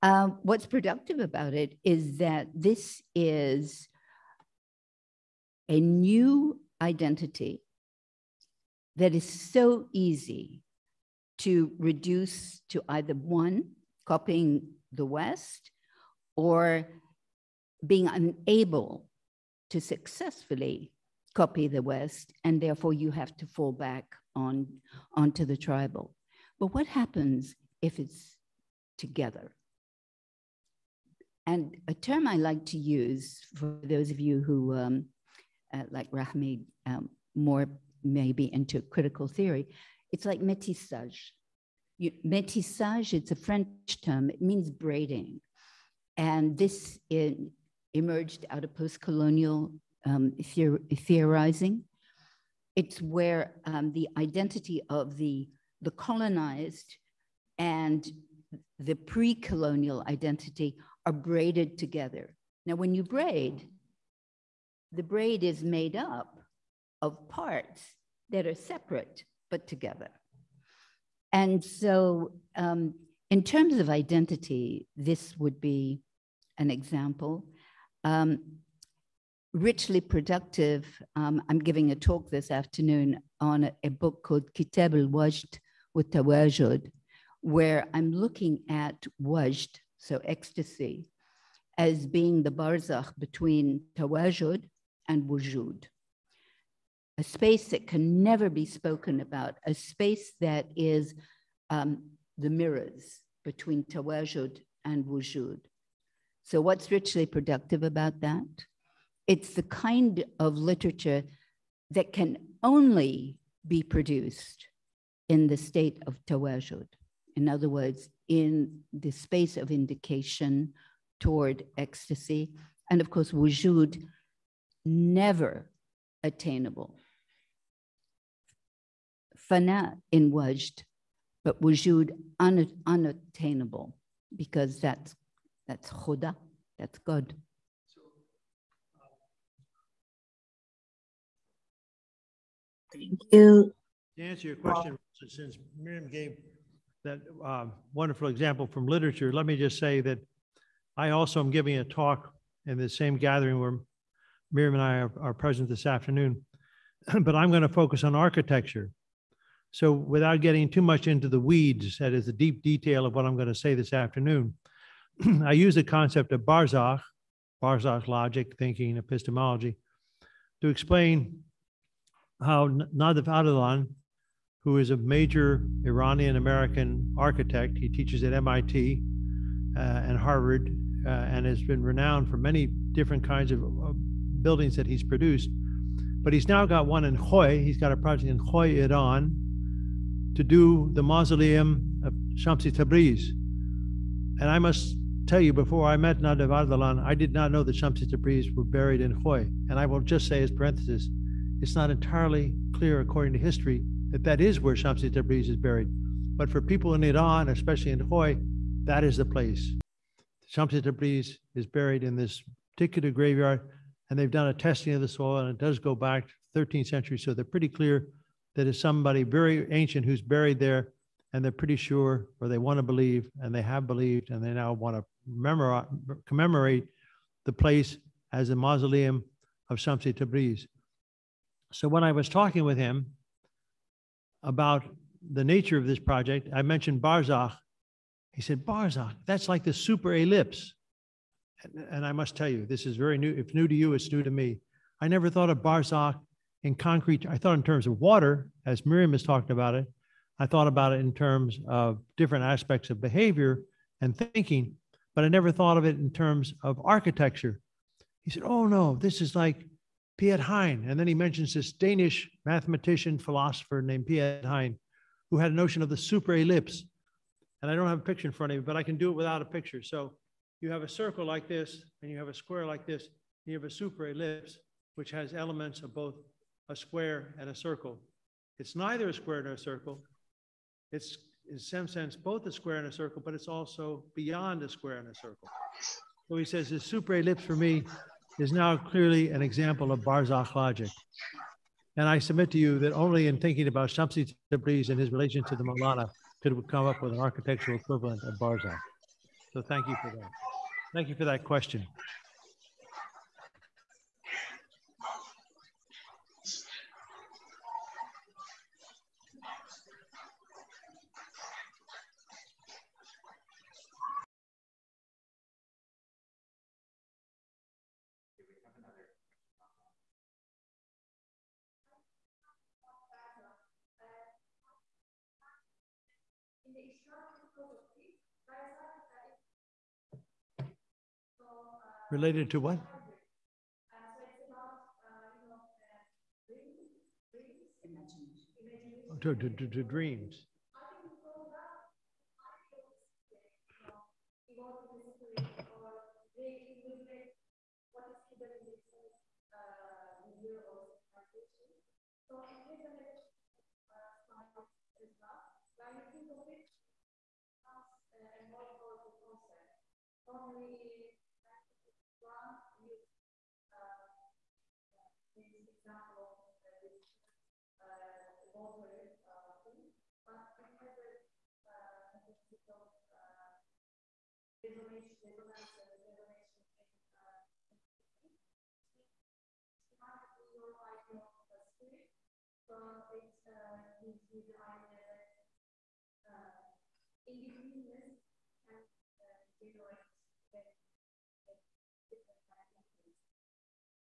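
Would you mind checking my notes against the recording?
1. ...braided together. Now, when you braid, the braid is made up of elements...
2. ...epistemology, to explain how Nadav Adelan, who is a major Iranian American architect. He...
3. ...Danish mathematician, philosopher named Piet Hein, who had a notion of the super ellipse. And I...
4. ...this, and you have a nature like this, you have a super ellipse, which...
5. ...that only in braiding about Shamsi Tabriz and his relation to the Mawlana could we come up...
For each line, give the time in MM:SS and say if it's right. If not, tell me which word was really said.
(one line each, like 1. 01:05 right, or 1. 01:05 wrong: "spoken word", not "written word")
1. 01:01 wrong: "parts", not "elements"
2. 02:48 right
3. 04:21 right
4. 04:31 wrong: "square", not "nature"
5. 04:52 wrong: "thinking", not "braiding".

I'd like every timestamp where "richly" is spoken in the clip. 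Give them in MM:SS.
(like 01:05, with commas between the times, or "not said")
01:19, 01:46.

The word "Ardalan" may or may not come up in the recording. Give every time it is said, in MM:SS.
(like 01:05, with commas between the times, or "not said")
03:16.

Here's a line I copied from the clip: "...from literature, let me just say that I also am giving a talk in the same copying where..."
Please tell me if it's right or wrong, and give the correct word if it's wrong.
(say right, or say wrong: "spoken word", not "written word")
wrong: "gathering", not "copying".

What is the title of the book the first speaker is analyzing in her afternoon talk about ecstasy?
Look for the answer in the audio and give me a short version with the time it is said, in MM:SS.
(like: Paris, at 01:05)
Kitab al Wajd, at 01:24.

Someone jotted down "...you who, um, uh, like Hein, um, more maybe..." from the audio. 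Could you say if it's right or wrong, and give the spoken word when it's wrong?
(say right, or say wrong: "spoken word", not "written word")
wrong: "Rahmi", not "Hein".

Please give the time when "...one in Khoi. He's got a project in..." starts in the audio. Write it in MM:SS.
03:06.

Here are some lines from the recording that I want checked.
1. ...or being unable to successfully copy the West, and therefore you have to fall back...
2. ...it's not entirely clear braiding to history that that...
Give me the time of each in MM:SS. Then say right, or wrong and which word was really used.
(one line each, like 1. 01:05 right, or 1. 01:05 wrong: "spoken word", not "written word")
1. 00:16 right
2. 03:21 wrong: "according", not "braiding".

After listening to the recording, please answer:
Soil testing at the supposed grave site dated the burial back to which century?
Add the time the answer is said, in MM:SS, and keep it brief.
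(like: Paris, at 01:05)
13th century, at 03:36.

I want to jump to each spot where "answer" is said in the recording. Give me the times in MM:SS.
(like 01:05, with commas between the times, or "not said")
02:24.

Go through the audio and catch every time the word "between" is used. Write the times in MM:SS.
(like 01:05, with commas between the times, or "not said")
01:33, 01:43.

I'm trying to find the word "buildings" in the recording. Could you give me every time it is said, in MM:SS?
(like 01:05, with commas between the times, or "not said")
03:04.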